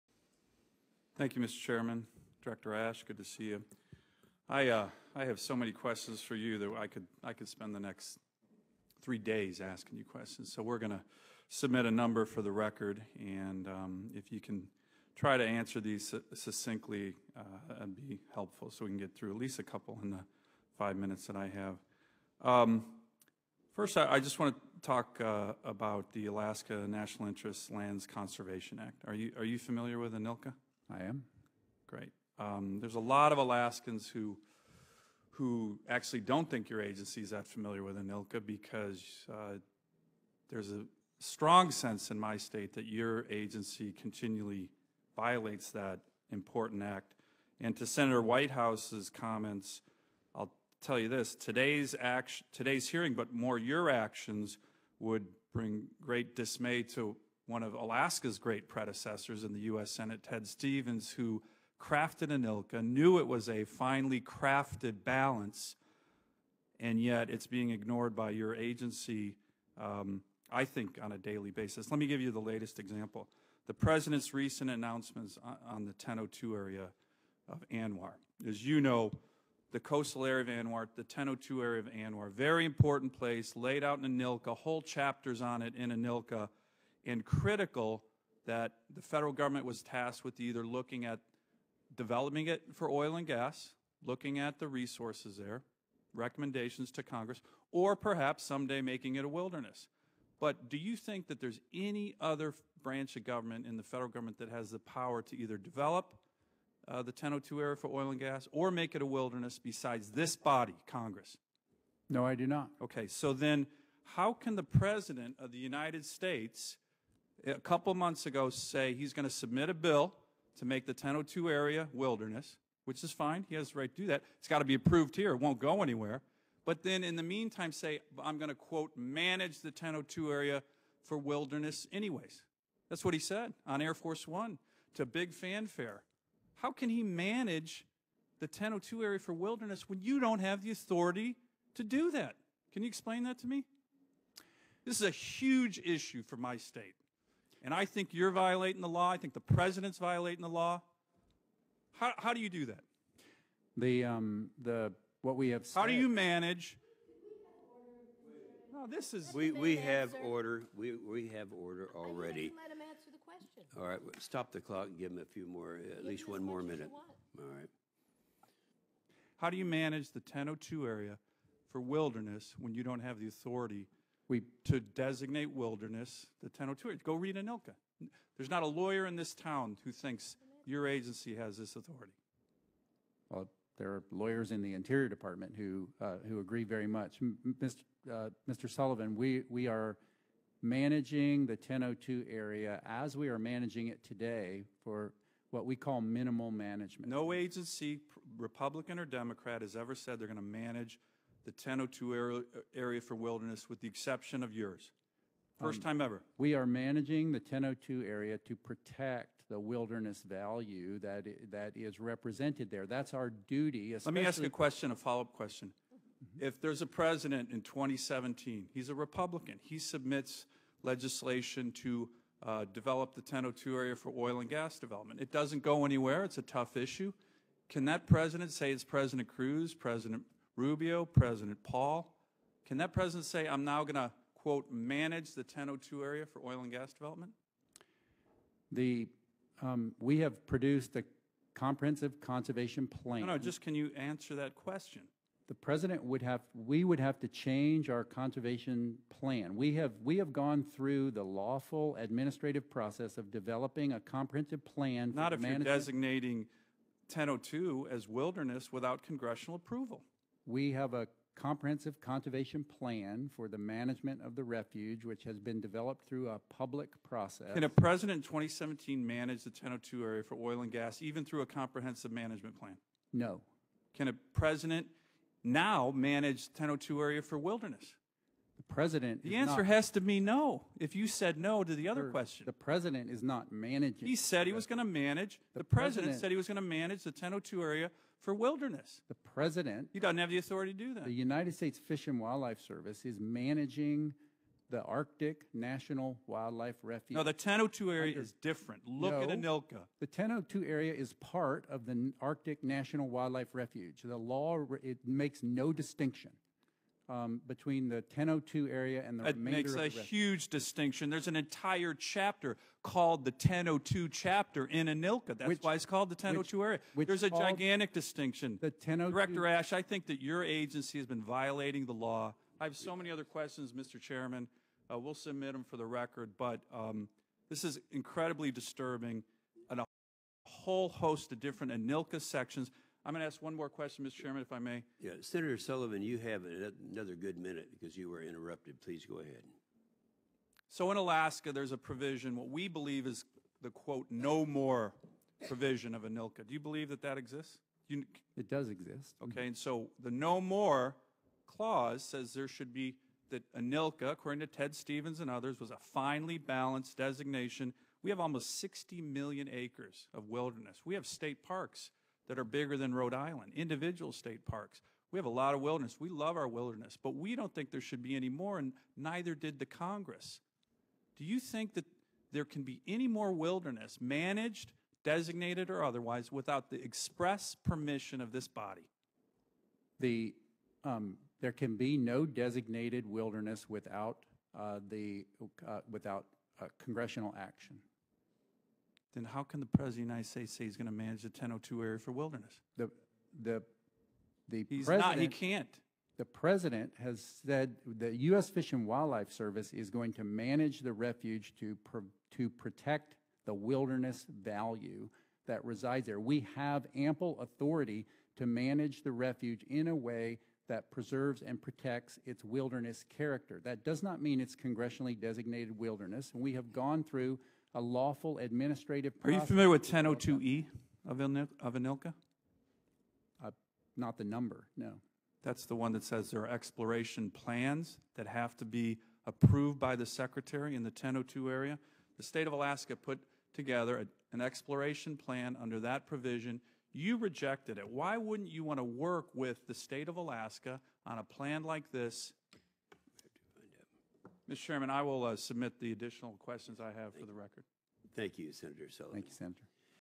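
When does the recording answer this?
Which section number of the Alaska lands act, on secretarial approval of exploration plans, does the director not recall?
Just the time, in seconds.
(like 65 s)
419 s.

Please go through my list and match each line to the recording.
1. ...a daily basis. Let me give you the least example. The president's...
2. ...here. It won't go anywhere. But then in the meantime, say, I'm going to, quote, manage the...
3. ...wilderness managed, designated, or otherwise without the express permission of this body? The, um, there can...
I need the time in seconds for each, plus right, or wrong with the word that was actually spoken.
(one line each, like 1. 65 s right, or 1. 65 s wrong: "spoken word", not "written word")
1. 71 s wrong: "latest", not "least"
2. 125 s right
3. 373 s right.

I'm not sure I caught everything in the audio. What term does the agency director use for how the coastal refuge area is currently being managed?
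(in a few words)
minimal management.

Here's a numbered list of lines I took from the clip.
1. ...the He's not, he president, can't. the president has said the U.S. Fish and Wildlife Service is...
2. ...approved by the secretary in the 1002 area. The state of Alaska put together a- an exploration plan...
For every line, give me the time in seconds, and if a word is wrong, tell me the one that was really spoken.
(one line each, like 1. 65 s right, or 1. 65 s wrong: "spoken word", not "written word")
1. 394 s right
2. 429 s right.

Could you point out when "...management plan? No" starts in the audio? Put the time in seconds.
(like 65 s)
272 s.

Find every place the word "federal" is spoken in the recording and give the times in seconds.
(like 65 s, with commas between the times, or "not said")
89 s, 103 s.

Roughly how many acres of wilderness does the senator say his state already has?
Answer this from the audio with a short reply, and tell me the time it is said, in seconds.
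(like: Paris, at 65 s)
almost 60 million acres, at 358 s.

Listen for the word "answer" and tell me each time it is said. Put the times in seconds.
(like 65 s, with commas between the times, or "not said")
15 s, 162 s, 243 s, 279 s.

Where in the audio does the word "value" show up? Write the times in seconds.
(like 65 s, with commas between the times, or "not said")
210 s, 404 s.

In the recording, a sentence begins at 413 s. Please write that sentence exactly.
That does not mean it's congressionally designated wilderness.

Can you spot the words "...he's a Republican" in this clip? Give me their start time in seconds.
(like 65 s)
218 s.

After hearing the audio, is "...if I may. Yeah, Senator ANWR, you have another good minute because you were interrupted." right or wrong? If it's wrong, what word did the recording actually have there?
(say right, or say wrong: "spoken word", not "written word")
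wrong: "Sullivan", not "ANWR".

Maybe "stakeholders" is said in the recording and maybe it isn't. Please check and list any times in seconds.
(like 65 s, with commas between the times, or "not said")
not said.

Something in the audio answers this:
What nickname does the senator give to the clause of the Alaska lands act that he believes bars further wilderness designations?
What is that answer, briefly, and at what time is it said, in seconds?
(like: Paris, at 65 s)
no more provision, at 344 s.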